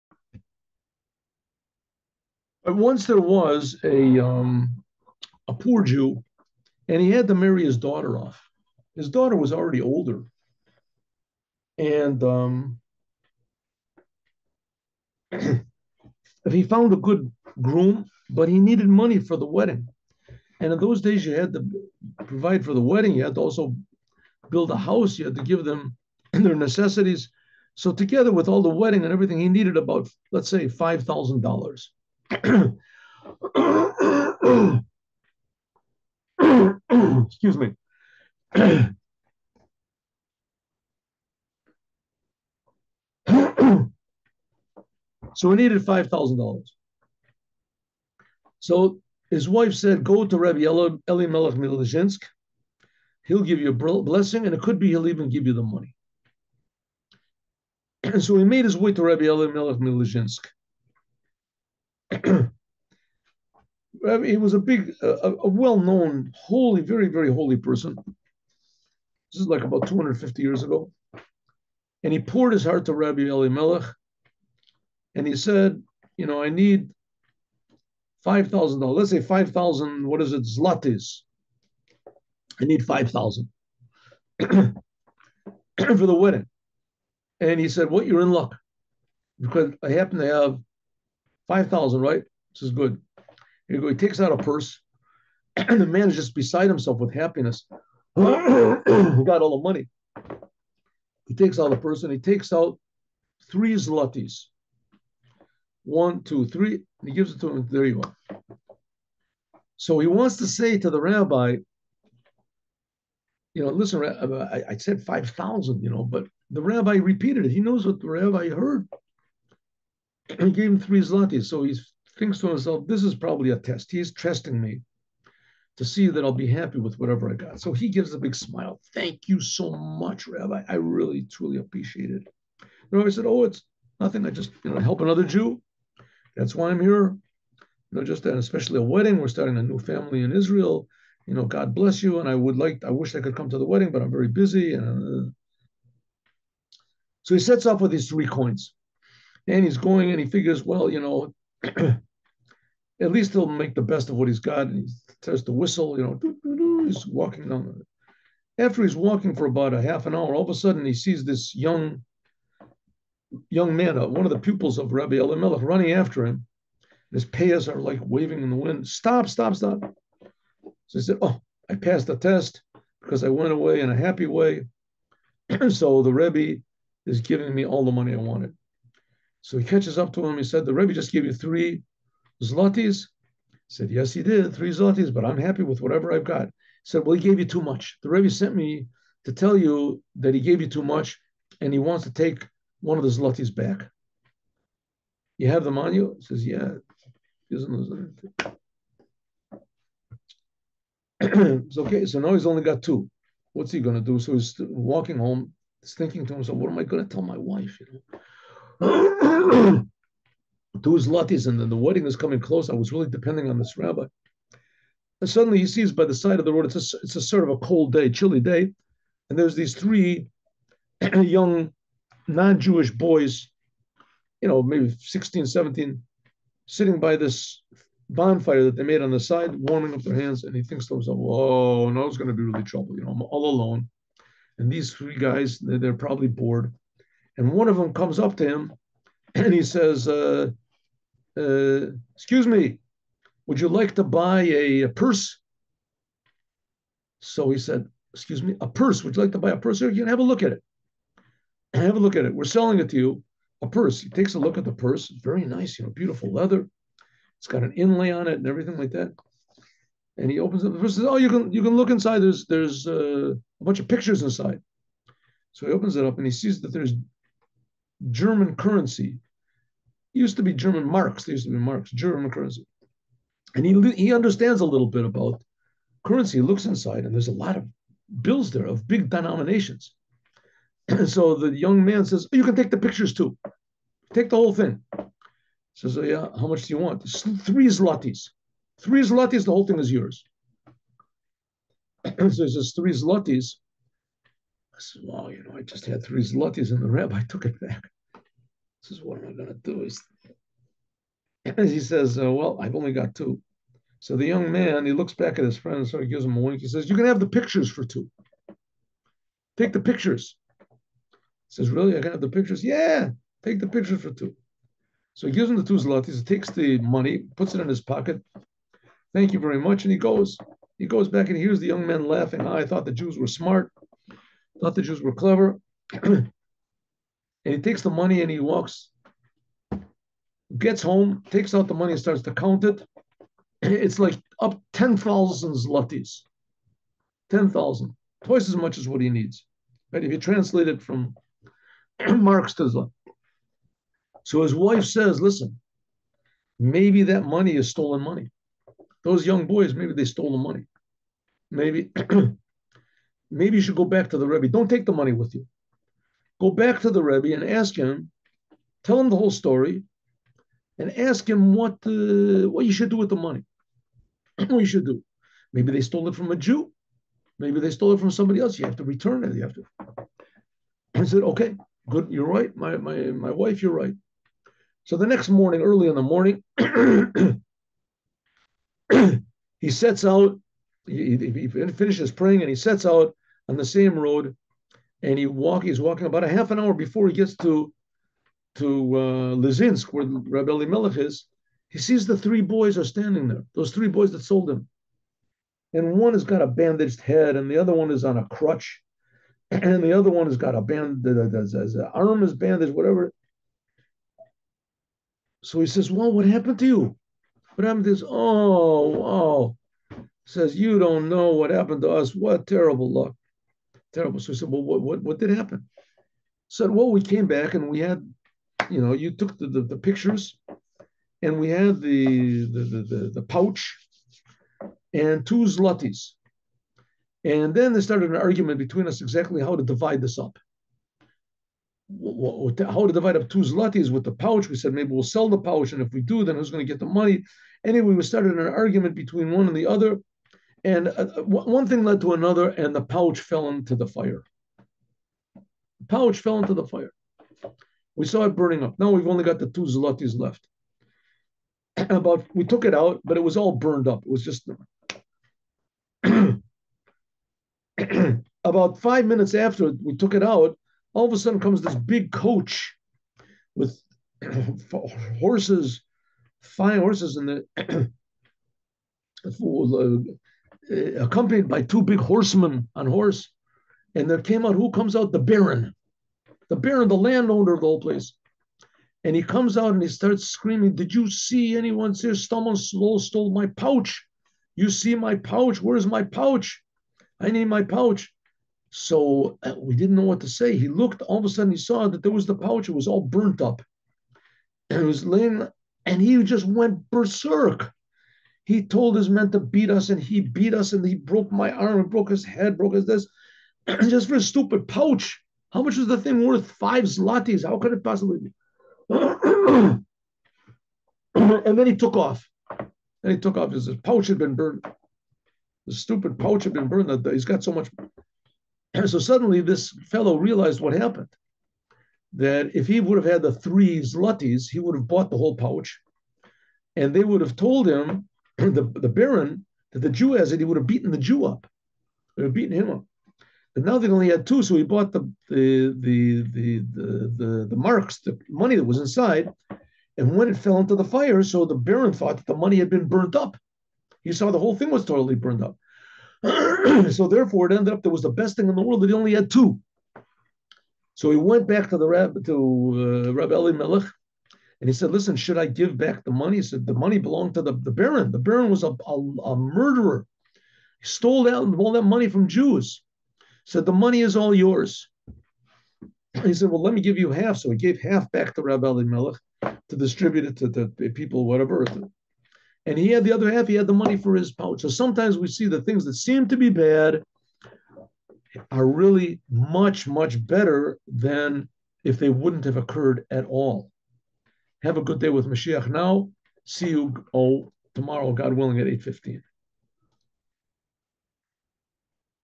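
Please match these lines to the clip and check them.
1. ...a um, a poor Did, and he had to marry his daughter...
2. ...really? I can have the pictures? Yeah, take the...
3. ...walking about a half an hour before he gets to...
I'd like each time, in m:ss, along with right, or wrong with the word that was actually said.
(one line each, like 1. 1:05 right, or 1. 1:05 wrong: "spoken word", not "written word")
1. 0:03 wrong: "Jew", not "Did"
2. 5:11 right
3. 6:25 right.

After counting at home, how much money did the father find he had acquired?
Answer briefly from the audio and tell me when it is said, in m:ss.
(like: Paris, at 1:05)
10,000 zlotys, at 5:34.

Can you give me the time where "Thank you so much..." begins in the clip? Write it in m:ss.
2:08.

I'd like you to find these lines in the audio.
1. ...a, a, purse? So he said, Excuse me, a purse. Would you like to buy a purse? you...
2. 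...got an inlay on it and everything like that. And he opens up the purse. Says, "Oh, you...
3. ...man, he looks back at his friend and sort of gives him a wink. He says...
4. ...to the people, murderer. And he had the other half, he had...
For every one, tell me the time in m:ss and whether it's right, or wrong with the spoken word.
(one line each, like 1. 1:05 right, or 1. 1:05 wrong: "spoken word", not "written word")
1. 4:04 right
2. 4:17 right
3. 5:04 right
4. 9:30 wrong: "whatever", not "murderer".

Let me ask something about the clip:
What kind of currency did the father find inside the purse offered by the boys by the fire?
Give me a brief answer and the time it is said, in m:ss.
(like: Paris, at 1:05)
German marks, at 4:30.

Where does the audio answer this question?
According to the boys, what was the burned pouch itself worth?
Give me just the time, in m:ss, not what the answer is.
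8:26.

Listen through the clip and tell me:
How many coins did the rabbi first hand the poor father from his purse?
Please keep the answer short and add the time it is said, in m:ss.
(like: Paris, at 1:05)
3, at 1:43.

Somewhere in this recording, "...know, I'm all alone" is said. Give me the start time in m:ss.
3:53.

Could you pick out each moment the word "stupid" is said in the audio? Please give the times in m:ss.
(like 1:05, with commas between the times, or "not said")
8:24, 8:35.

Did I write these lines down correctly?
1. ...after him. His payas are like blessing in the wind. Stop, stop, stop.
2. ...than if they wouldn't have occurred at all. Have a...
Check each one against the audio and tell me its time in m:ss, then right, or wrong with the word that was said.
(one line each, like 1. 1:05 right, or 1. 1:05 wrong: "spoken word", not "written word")
1. 2:45 wrong: "waving", not "blessing"
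2. 9:40 right.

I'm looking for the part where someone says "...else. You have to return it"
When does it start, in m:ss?
6:08.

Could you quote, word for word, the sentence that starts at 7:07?
And then they started an argument between us exactly how to divide this up.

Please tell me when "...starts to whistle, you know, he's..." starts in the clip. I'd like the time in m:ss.
2:35.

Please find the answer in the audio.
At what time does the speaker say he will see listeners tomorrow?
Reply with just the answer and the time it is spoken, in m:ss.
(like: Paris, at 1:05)
8:15, at 9:48.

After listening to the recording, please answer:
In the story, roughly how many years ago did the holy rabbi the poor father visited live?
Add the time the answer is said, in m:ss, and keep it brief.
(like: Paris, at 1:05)
250, at 1:09.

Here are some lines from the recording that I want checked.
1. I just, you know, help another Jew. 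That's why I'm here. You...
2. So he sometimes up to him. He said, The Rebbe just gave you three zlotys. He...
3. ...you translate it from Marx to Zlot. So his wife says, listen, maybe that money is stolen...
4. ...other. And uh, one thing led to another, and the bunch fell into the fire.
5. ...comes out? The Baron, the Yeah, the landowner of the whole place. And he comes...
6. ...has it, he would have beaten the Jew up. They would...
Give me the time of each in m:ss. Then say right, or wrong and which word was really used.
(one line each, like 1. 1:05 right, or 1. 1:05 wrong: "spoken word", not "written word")
1. 2:14 right
2. 2:59 wrong: "catches", not "sometimes"
3. 5:40 right
4. 7:19 wrong: "pouch", not "bunch"
5. 7:54 wrong: "Baron", not "Yeah"
6. 8:50 right.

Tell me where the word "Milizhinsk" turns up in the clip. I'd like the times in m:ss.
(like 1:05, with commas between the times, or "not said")
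0:51, 0:59.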